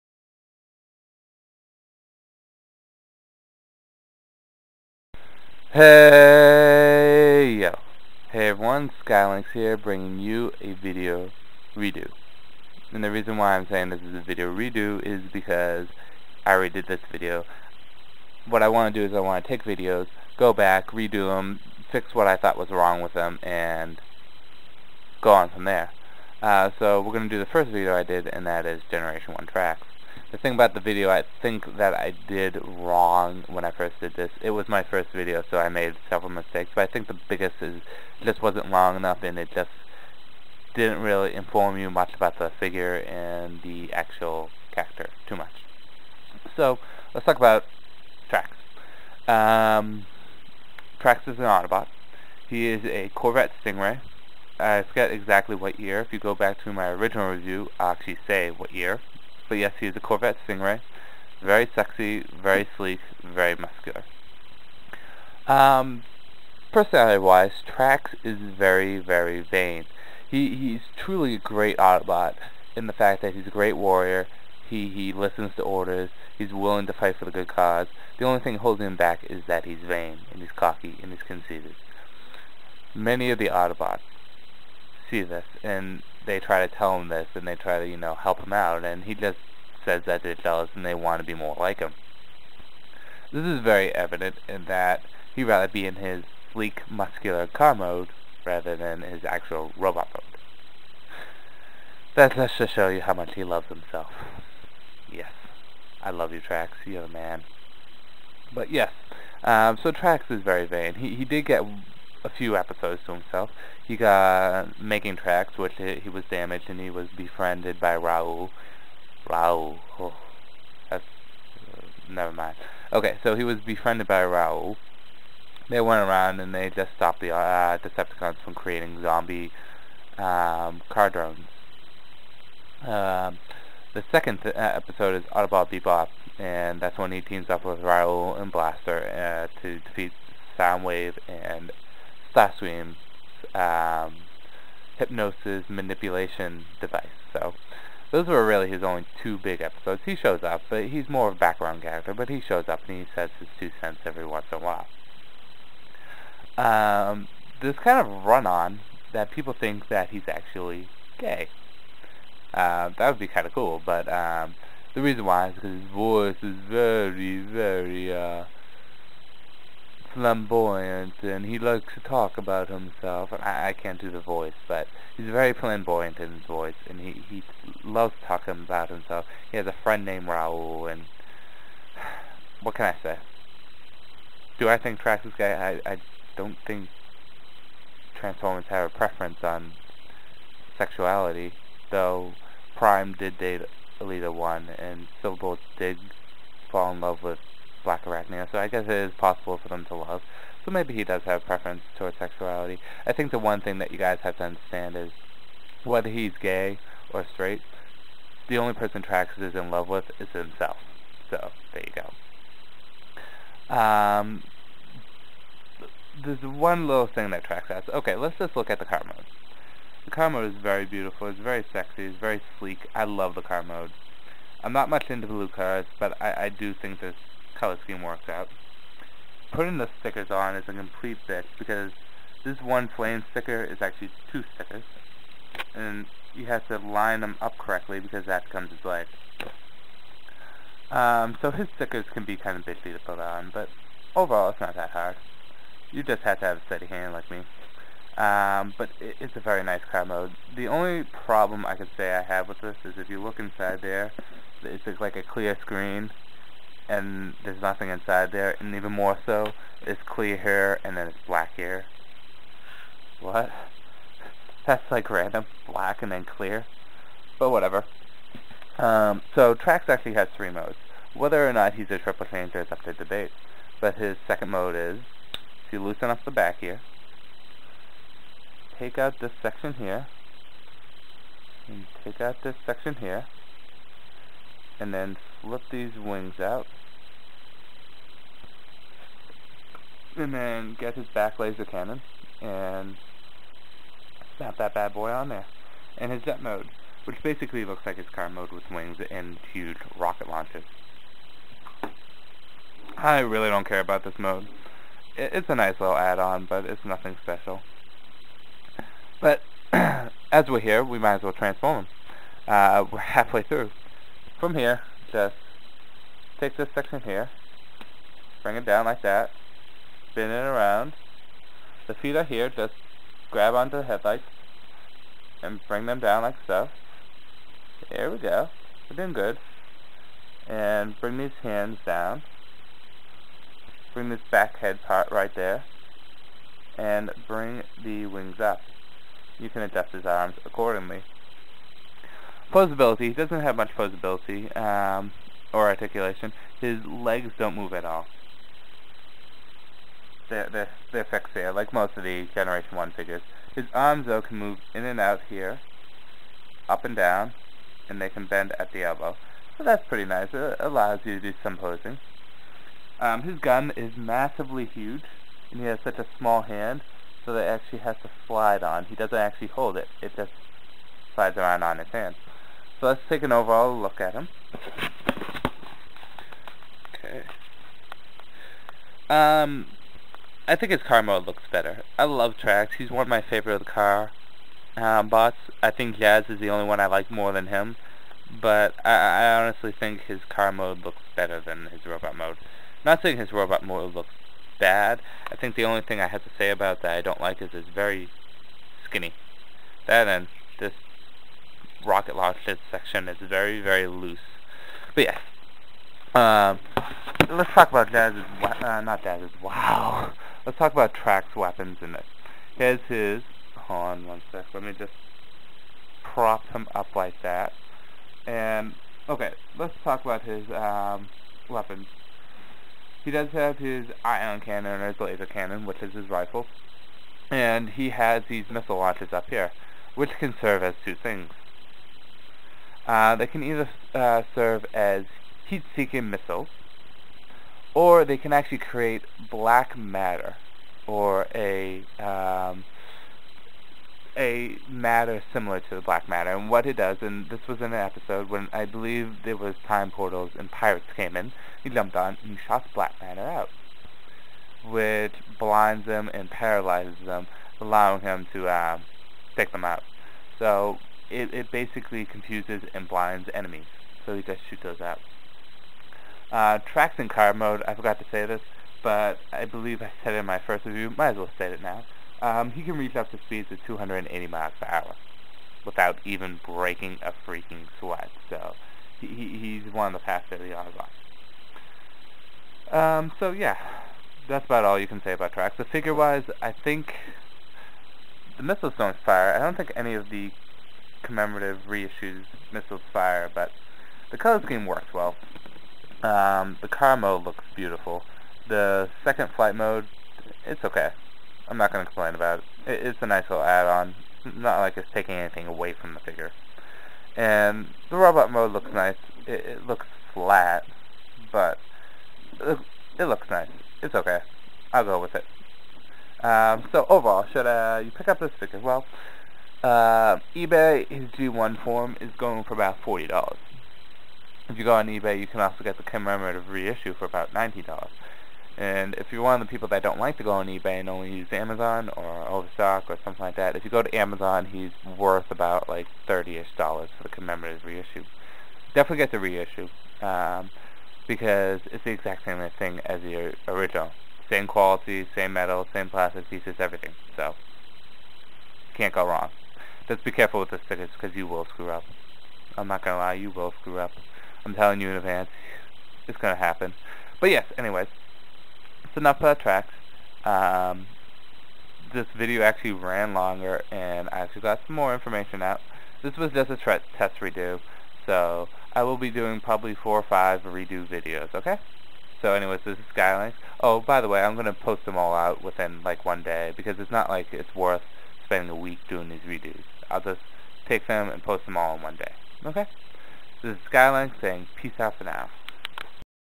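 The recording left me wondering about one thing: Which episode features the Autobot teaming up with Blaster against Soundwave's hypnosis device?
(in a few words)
Autobot Bebop.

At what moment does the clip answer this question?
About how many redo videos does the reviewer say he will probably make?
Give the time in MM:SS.
09:29.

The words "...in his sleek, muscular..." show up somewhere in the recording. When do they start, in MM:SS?
01:35.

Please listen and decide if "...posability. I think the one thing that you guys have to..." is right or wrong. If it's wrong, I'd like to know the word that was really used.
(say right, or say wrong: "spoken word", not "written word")
wrong: "sexuality", not "posability".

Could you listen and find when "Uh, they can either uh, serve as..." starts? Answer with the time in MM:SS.
07:12.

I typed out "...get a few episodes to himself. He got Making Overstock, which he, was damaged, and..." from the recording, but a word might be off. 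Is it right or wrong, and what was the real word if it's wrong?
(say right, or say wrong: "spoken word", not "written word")
wrong: "Tracks", not "Overstock".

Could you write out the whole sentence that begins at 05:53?
His arms, though, can move in and out here, up and down, and they can bend at the elbow.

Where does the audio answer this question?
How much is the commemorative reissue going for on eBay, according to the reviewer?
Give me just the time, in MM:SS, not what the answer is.
08:47.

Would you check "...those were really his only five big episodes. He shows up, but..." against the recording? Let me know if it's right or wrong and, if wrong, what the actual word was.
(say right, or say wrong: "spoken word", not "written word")
wrong: "two", not "five".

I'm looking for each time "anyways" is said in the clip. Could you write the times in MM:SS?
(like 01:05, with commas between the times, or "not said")
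09:17, 09:32.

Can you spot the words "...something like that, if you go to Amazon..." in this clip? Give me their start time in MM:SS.
08:53.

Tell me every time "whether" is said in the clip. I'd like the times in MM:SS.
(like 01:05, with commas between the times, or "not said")
03:25, 04:31.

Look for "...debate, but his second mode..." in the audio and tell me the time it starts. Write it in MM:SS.
04:32.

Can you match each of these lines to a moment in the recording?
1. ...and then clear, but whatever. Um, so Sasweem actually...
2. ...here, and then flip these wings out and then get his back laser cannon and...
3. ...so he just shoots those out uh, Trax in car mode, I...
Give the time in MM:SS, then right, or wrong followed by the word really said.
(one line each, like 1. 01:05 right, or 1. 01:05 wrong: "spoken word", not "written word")
1. 04:26 wrong: "Trax", not "Sasweem"
2. 04:42 right
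3. 07:44 right.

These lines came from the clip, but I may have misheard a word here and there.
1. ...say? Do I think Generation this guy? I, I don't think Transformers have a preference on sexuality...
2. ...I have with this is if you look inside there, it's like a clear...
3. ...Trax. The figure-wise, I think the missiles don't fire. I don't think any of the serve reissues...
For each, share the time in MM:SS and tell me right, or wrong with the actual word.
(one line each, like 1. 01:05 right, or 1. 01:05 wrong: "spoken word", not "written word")
1. 03:03 wrong: "Trax", not "Generation"
2. 04:12 right
3. 08:05 wrong: "commemorative", not "serve".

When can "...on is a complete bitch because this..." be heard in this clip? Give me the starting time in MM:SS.
03:50.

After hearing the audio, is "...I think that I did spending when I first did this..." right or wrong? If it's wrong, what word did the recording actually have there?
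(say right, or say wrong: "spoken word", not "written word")
wrong: "wrong", not "spending".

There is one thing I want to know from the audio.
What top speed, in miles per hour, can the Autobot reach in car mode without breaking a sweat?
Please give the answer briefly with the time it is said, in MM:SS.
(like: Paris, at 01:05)
280, at 07:53.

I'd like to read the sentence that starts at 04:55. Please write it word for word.
And his jet mode, which basically looks like his car mode with wings and huge rocket launches.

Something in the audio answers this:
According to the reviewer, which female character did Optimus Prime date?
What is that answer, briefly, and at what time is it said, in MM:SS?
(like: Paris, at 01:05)
Elita-1, at 03:13.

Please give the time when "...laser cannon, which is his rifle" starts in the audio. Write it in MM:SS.
07:04.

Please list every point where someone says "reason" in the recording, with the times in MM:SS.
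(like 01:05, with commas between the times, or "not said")
00:13, 02:45.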